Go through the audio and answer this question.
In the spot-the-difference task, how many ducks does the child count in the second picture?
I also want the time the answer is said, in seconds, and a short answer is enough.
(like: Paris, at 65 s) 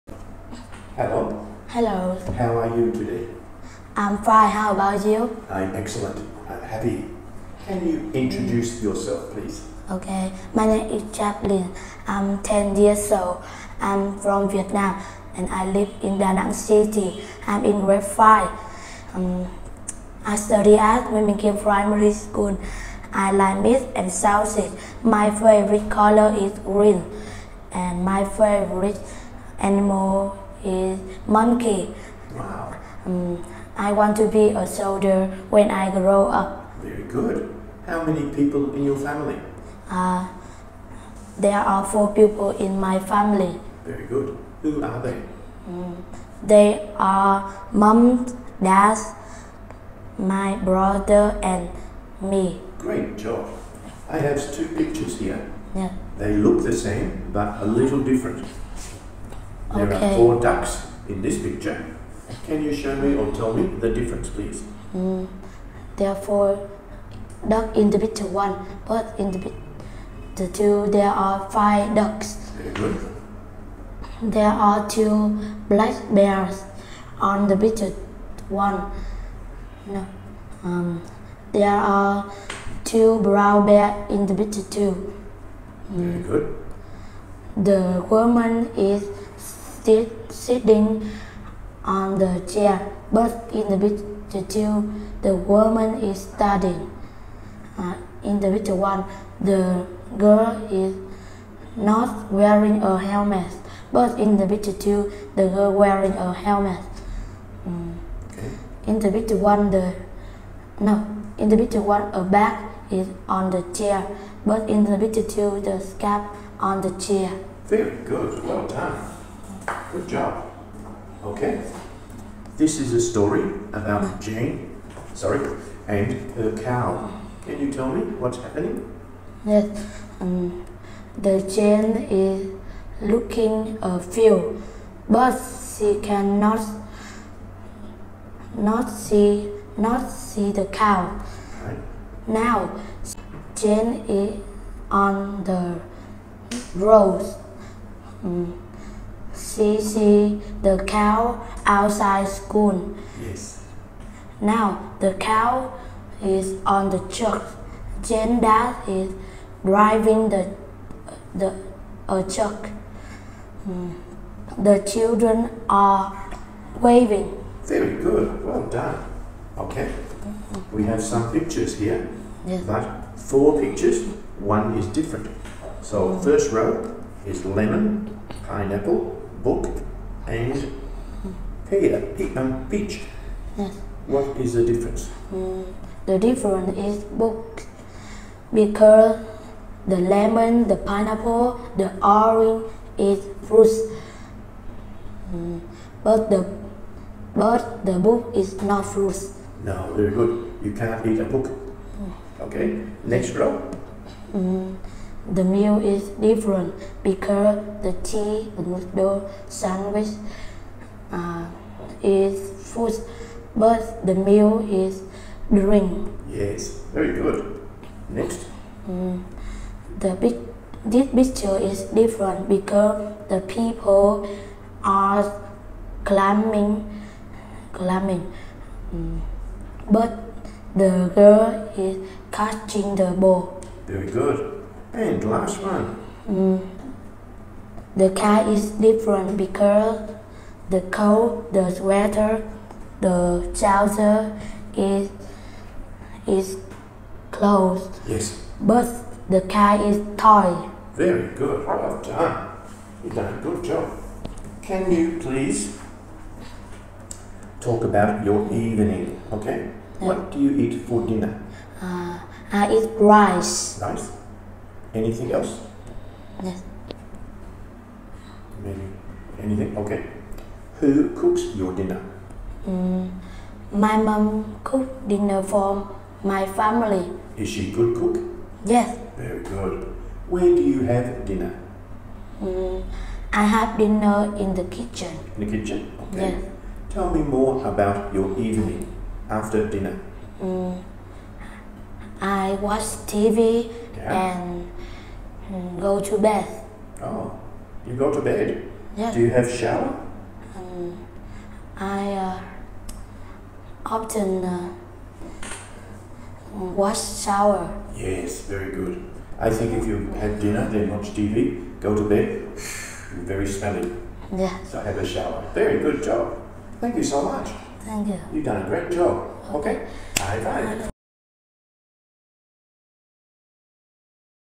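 5, at 71 s.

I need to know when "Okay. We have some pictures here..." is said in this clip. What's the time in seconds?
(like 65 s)
169 s.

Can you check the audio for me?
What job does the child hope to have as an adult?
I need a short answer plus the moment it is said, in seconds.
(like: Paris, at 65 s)
soldier, at 34 s.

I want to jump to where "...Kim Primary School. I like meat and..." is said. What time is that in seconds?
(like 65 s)
21 s.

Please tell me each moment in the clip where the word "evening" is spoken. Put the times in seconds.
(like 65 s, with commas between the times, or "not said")
258 s, 288 s.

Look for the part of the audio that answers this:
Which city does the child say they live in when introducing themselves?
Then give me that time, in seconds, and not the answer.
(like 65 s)
16 s.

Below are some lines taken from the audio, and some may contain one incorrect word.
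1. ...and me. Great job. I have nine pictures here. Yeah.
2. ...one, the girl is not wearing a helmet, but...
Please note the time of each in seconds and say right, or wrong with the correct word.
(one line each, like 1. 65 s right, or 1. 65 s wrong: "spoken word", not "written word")
1. 51 s wrong: "two", not "nine"
2. 98 s right.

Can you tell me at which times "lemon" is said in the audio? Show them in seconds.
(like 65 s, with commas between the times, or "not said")
177 s, 189 s.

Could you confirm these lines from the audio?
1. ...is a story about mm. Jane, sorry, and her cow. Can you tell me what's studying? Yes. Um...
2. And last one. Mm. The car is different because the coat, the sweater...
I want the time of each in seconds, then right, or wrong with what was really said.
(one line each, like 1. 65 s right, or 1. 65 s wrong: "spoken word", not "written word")
1. 122 s wrong: "happening", not "studying"
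2. 234 s right.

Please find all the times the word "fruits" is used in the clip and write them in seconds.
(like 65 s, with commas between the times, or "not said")
193 s, 198 s.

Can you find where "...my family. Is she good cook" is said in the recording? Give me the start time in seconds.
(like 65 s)
276 s.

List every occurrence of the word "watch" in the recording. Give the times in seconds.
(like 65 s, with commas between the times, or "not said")
292 s, 310 s.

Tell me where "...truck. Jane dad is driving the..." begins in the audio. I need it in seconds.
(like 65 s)
157 s.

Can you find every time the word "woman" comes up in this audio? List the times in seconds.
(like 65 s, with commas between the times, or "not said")
88 s, 95 s.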